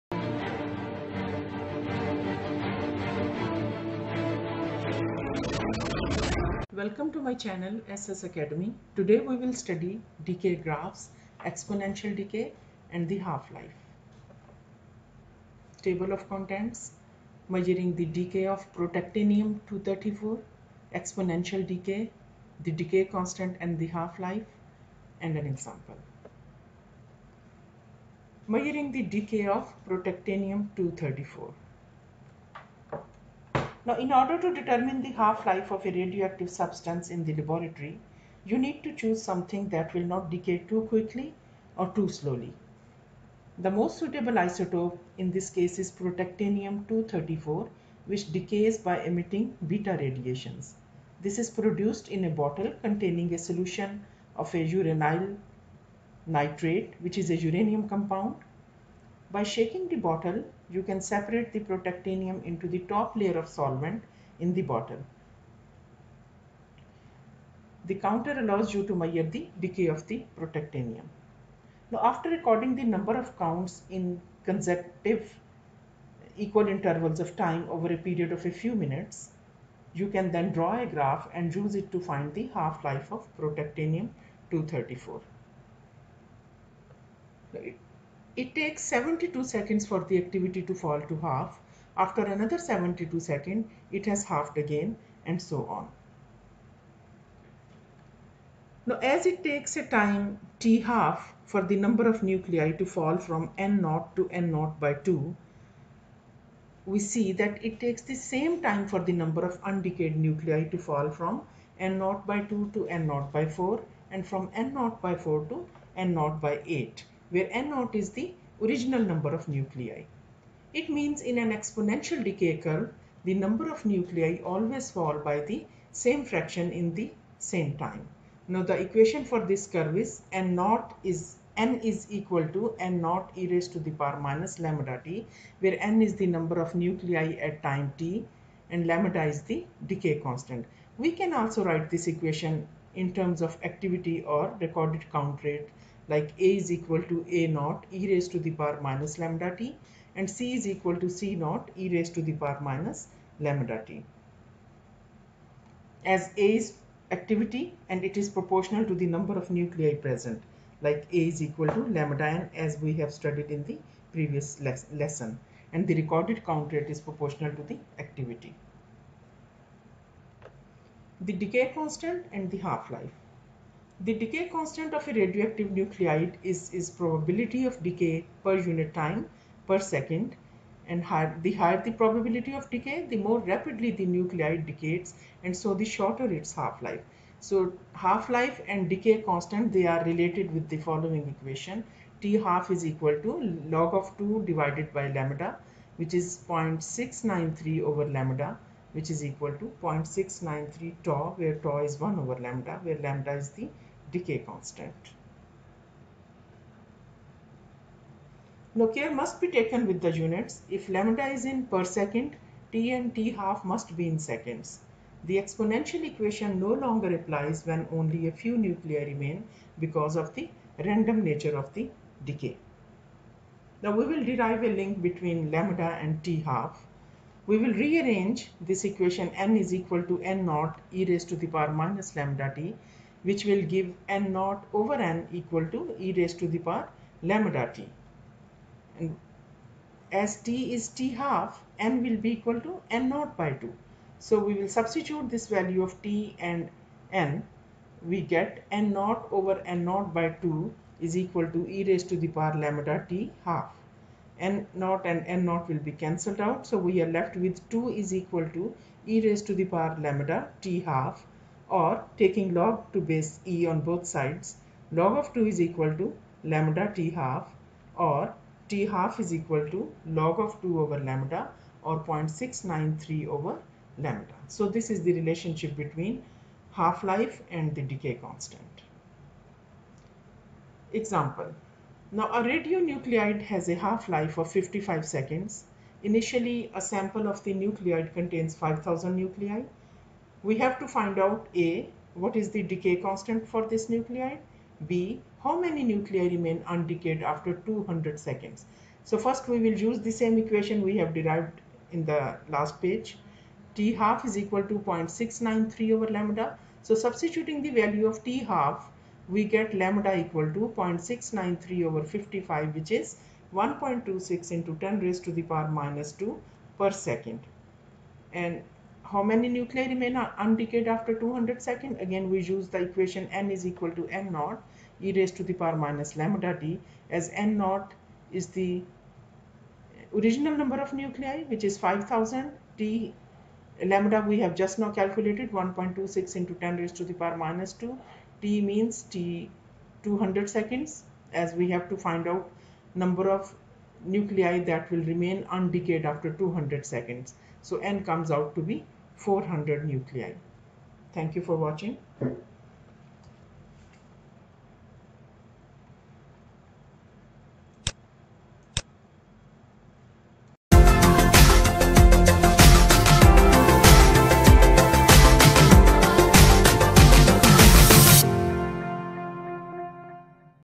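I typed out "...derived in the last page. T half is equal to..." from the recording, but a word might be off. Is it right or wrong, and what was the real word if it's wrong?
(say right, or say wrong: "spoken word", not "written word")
right.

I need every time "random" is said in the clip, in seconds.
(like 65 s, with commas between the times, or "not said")
220 s.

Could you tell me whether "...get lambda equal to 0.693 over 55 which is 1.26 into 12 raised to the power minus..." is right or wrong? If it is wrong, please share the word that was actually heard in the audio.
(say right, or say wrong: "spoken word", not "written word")
wrong: "10", not "12".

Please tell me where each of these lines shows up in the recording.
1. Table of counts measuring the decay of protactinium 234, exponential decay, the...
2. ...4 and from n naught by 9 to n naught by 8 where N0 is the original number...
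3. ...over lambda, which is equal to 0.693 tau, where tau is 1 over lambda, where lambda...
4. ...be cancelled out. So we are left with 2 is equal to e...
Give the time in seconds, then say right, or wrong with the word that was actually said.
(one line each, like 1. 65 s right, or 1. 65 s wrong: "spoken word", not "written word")
1. 15 s wrong: "contents", not "counts"
2. 113 s wrong: "4", not "9"
3. 197 s right
4. 255 s right.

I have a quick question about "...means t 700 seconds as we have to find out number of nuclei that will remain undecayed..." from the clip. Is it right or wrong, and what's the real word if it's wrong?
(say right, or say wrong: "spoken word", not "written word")
wrong: "200", not "700".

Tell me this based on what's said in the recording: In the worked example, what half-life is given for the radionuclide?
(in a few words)
55 seconds.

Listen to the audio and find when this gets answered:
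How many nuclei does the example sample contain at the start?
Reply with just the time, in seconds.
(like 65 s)
288 s.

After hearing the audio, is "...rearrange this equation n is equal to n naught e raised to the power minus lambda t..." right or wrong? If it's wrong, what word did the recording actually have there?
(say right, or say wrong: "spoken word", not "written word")
right.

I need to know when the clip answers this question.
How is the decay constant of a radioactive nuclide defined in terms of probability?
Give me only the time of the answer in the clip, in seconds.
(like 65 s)
176 s.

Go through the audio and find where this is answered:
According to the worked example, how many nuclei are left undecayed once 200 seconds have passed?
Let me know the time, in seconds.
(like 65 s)
349 s.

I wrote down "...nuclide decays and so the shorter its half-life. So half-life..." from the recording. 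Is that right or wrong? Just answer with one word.
right.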